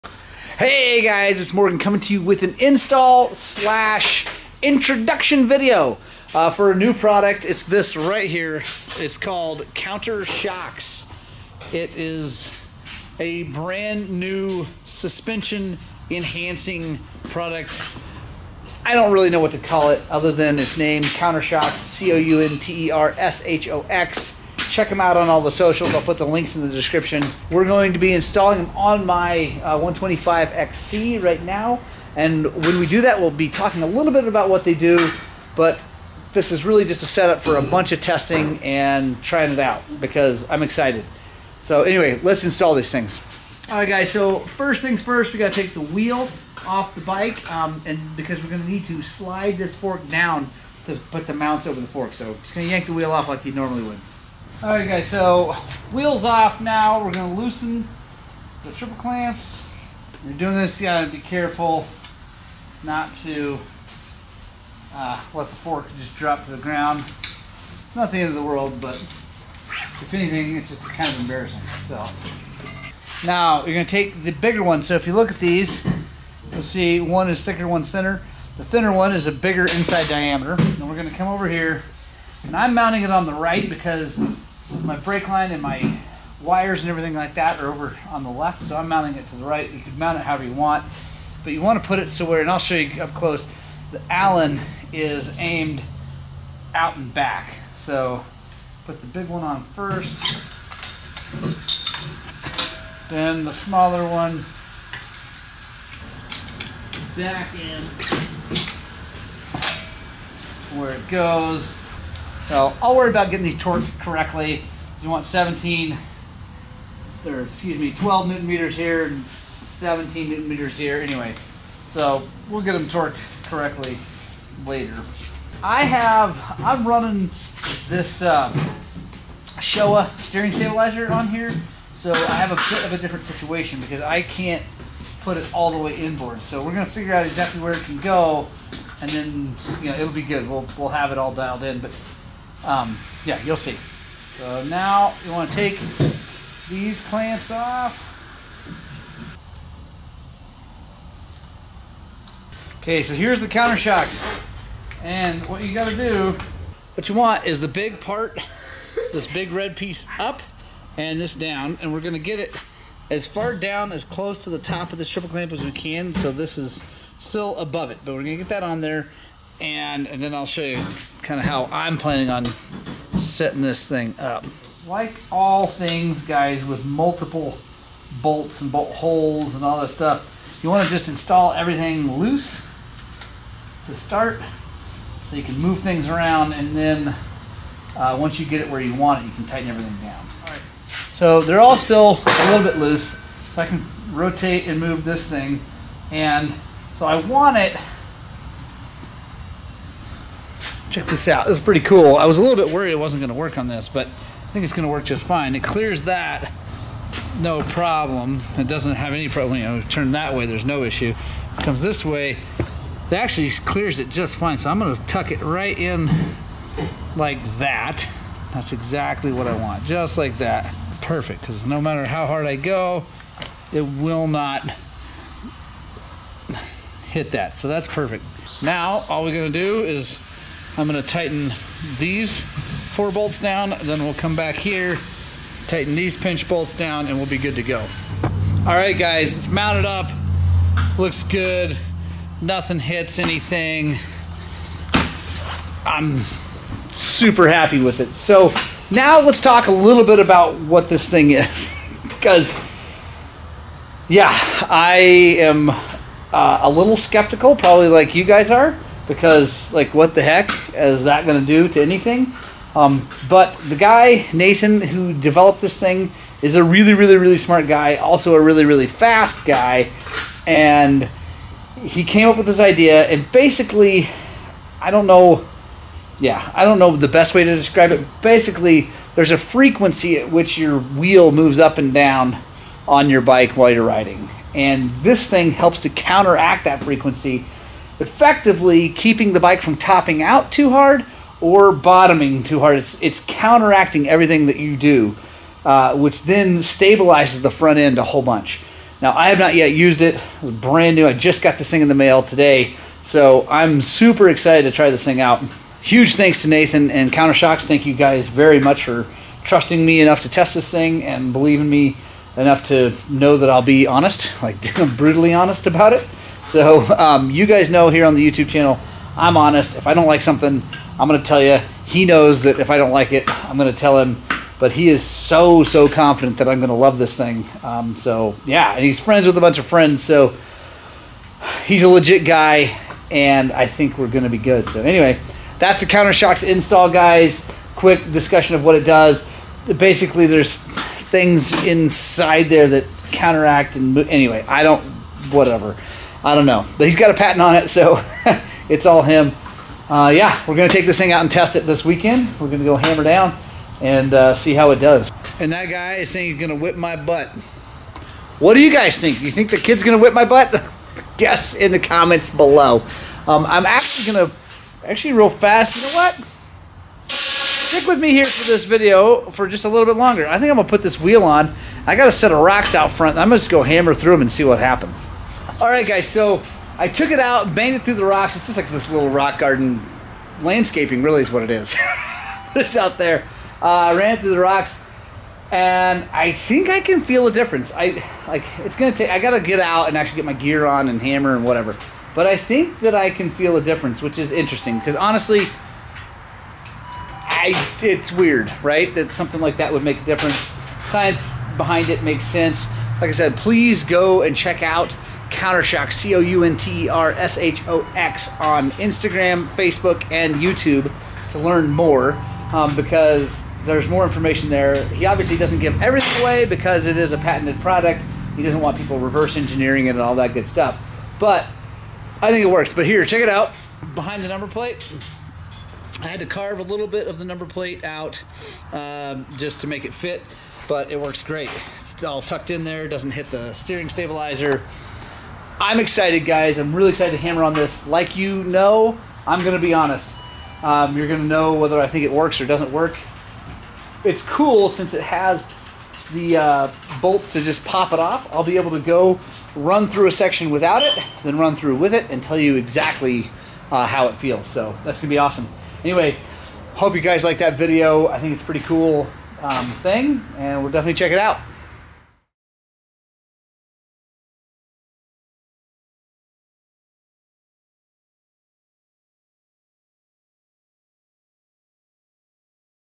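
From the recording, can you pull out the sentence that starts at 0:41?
So anyway, let's install these things.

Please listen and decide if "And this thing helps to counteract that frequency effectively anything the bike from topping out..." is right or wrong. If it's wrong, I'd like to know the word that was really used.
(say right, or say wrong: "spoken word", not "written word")
wrong: "keeping", not "anything".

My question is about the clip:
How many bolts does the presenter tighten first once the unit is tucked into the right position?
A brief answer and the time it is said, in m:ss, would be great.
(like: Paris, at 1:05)
4, at 3:52.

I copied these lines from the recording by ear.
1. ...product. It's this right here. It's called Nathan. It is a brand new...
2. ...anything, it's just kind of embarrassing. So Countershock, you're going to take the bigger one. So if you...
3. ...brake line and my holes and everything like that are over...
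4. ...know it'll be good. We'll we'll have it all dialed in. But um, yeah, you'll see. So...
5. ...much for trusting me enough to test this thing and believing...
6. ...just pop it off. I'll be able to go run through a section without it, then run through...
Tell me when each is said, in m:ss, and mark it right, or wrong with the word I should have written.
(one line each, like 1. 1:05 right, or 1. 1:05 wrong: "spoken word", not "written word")
1. 0:06 wrong: "CounterShox", not "Nathan"
2. 1:10 wrong: "Now", not "Countershock"
3. 1:24 wrong: "wires", not "holes"
4. 2:19 right
5. 5:08 right
6. 7:27 right.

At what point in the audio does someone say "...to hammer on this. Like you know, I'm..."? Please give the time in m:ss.
7:17.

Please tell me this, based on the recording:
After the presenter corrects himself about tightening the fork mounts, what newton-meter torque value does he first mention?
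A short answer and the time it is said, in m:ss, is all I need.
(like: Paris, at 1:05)
12, at 1:57.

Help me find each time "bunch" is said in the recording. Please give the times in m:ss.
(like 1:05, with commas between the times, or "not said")
0:37, 4:58, 5:29.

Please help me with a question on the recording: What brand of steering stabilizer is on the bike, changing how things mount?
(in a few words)
Showa.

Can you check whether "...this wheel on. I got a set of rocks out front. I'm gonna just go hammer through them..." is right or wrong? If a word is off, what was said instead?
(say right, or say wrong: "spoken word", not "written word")
right.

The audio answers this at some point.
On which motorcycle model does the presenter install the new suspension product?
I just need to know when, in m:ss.
0:29.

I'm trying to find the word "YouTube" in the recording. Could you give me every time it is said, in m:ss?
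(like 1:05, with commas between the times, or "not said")
5:18, 6:50.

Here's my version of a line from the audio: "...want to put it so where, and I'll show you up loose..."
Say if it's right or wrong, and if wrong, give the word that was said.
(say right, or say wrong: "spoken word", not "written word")
wrong: "close", not "loose".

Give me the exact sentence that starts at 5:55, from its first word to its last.
And that guy is saying he's gonna whip my butt.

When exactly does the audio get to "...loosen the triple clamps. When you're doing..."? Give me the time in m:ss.
0:57.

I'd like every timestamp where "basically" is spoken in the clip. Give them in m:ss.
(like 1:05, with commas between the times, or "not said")
4:33, 4:38, 5:39.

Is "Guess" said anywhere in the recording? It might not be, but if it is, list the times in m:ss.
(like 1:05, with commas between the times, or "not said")
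6:01.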